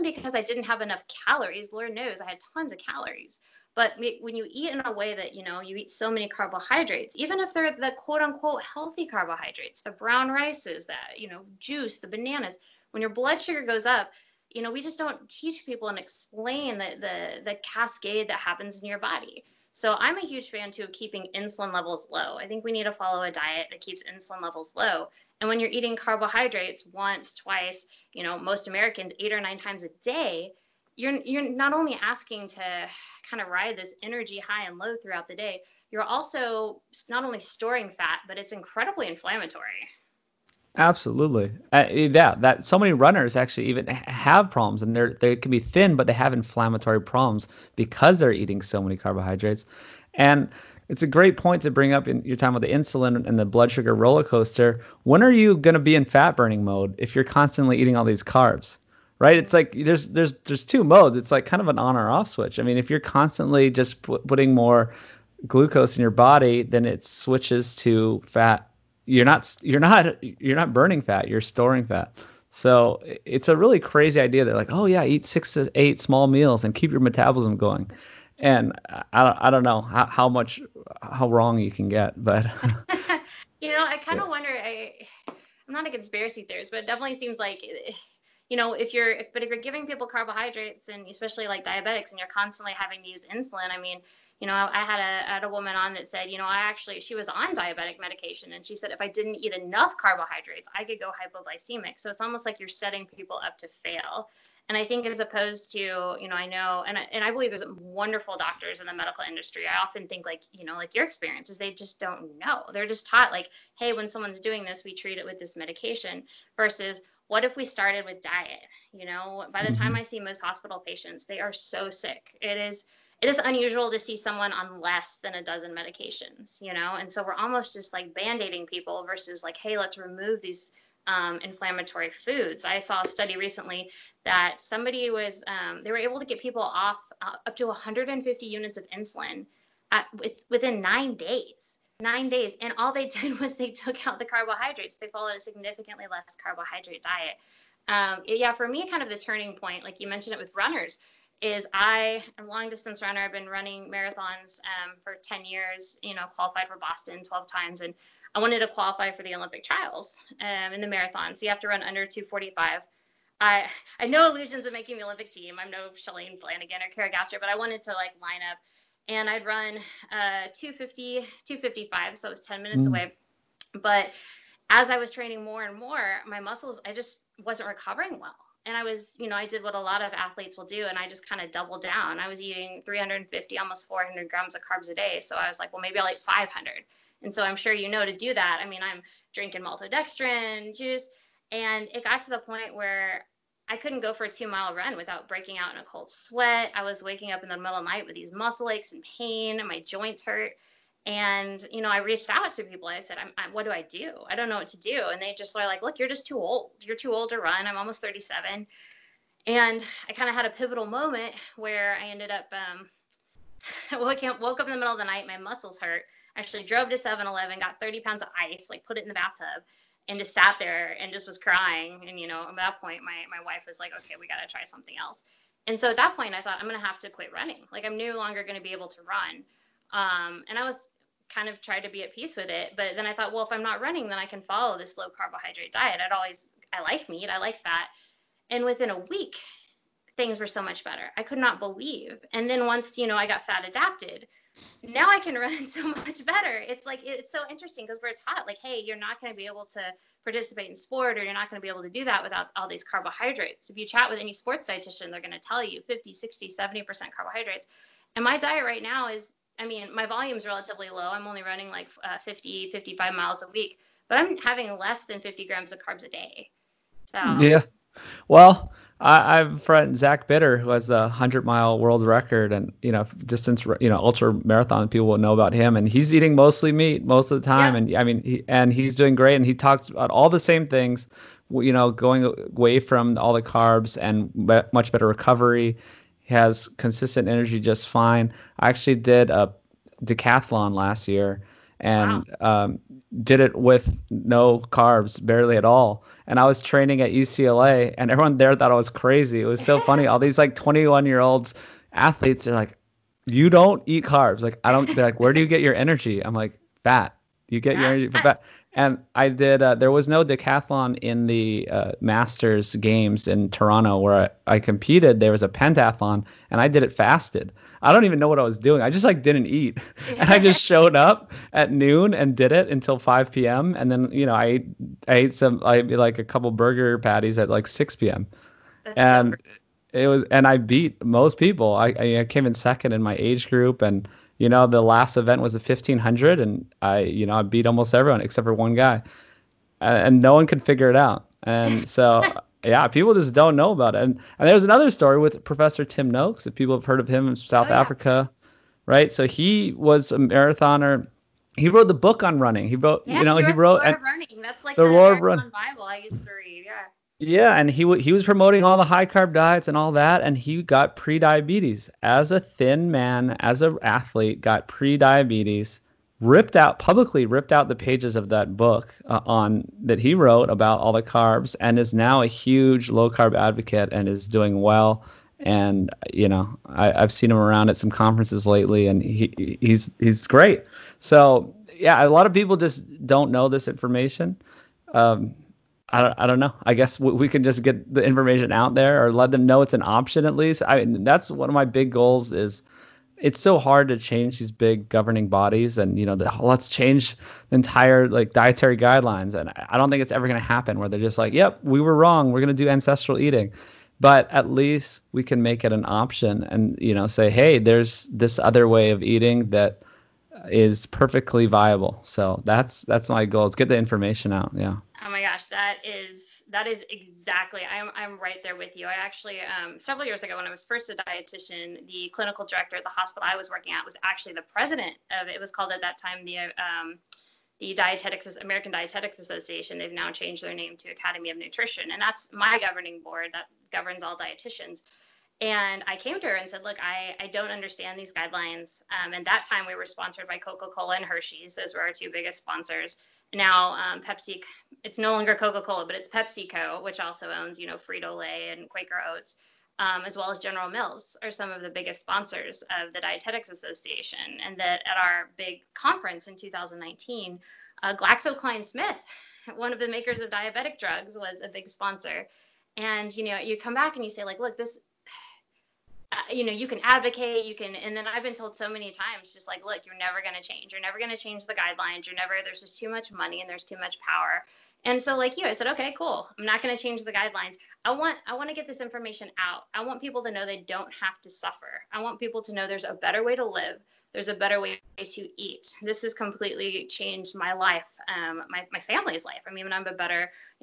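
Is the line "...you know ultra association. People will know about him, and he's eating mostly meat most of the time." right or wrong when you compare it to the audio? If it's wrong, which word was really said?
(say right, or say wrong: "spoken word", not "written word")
wrong: "marathon", not "association".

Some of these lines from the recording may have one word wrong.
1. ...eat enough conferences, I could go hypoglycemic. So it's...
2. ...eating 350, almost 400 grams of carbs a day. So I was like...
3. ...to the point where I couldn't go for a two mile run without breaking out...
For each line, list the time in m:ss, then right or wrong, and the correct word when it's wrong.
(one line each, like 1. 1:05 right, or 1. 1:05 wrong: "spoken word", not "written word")
1. 1:39 wrong: "carbohydrates", not "conferences"
2. 3:02 right
3. 3:12 right.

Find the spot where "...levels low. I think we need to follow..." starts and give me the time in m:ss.
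0:21.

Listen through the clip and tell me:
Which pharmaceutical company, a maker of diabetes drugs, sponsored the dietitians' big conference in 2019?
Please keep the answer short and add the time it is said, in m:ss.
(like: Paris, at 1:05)
GlaxoSmithKline, at 7:37.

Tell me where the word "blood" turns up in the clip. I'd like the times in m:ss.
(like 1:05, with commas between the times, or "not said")
0:13, 0:53.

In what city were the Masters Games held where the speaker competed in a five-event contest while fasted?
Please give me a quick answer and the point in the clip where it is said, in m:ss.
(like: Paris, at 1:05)
Toronto, at 5:13.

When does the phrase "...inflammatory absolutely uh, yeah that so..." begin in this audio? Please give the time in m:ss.
0:39.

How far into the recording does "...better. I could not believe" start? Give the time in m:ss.
4:00.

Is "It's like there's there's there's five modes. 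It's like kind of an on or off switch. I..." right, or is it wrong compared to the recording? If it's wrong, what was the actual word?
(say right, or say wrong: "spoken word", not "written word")
wrong: "two", not "five".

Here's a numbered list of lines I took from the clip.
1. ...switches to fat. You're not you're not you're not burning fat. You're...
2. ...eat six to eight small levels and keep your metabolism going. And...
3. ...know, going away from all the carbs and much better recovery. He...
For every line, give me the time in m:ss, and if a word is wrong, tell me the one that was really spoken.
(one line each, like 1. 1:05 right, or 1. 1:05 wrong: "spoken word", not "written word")
1. 1:07 right
2. 1:15 wrong: "meals", not "levels"
3. 4:41 right.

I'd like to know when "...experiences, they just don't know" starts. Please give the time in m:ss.
1:51.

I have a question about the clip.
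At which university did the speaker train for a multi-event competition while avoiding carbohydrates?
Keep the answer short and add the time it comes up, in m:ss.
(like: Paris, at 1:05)
UCLA, at 4:57.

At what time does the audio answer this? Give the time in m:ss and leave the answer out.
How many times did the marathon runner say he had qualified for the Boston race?
2:37.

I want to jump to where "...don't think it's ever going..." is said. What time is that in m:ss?
6:39.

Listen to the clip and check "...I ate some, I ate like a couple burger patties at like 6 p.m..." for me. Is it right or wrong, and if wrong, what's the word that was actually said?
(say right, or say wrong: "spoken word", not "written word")
right.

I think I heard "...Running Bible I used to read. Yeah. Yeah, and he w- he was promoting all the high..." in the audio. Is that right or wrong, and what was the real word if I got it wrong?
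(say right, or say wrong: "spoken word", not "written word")
right.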